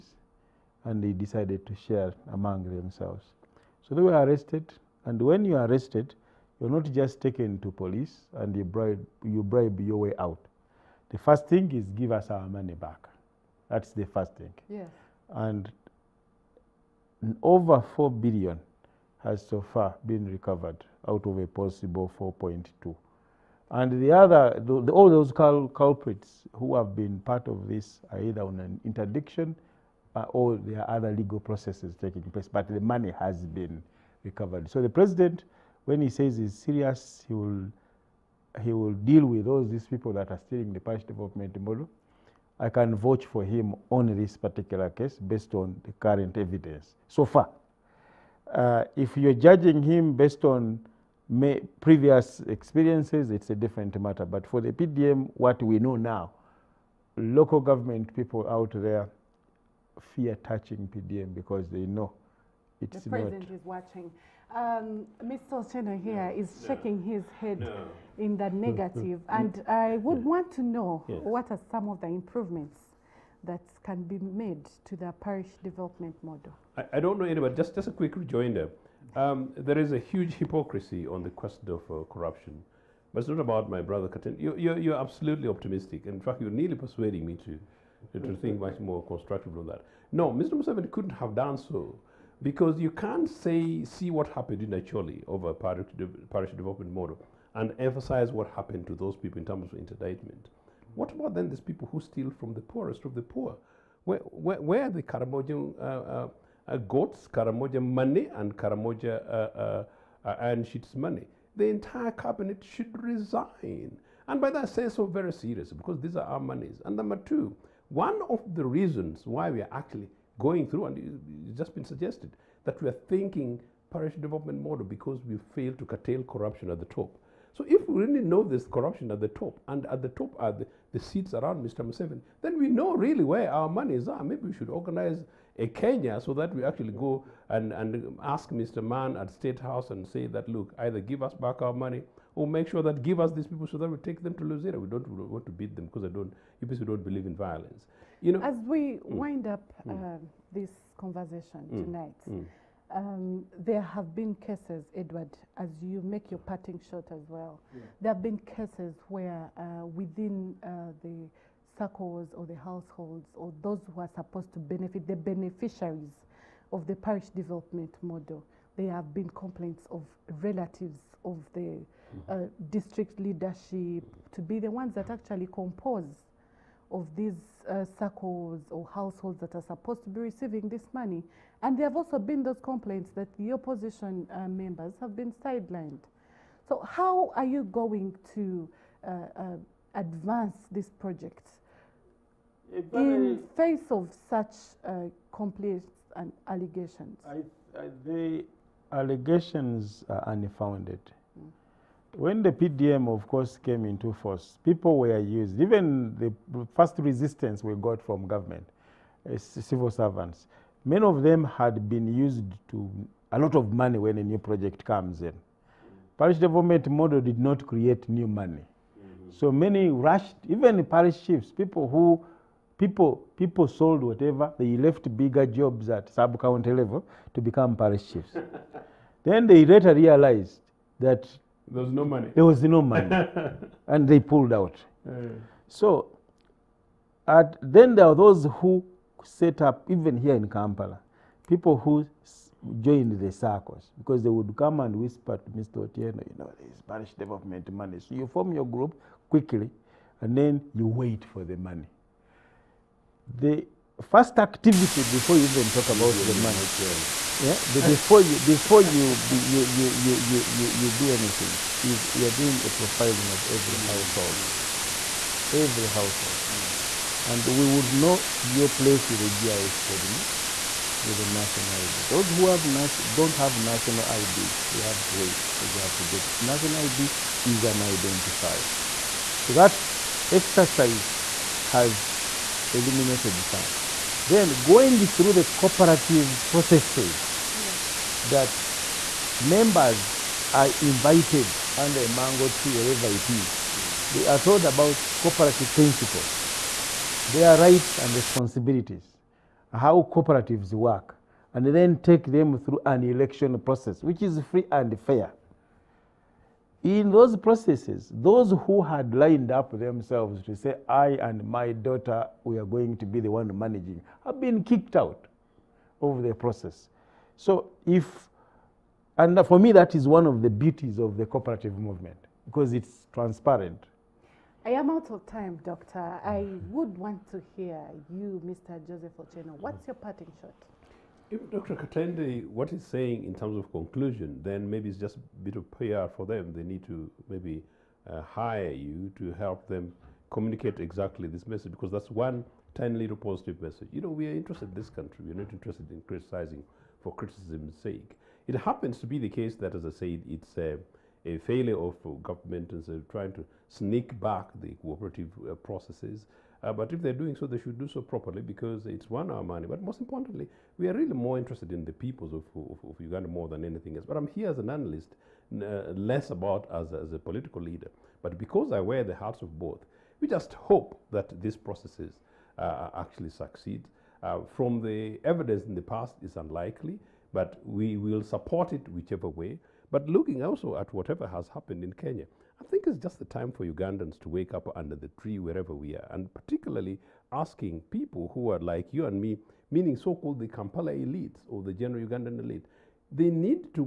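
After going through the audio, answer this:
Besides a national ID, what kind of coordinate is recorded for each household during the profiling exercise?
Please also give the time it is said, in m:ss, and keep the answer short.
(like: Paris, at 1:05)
GIS, at 4:29.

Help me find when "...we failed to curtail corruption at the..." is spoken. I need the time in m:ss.
2:05.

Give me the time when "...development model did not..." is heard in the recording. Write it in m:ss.
3:36.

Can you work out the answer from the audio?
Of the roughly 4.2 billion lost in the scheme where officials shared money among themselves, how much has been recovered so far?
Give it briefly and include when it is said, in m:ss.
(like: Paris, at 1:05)
over 4 billion, at 0:17.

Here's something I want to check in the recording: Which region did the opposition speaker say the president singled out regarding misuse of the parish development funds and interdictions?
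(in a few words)
Acholi.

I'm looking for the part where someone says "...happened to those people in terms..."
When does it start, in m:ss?
1:38.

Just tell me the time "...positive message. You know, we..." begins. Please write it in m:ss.
5:43.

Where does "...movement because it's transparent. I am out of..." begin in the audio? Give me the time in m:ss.
5:21.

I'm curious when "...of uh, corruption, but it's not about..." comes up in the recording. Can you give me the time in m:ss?
1:21.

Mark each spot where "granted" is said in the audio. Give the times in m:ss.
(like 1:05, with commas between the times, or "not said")
not said.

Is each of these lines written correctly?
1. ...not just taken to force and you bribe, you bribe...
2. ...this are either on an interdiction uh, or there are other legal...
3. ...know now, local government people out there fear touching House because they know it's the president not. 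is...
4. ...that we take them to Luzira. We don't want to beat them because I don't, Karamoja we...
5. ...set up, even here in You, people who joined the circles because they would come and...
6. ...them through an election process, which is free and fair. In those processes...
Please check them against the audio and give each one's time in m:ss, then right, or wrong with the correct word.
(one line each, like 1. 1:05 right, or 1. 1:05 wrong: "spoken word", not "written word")
1. 0:06 wrong: "police", not "force"
2. 0:27 right
3. 0:55 wrong: "PDM", not "House"
4. 2:23 wrong: "You", not "Karamoja"
5. 3:59 wrong: "Kampala", not "You"
6. 5:02 right.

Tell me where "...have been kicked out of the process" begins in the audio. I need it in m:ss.
5:14.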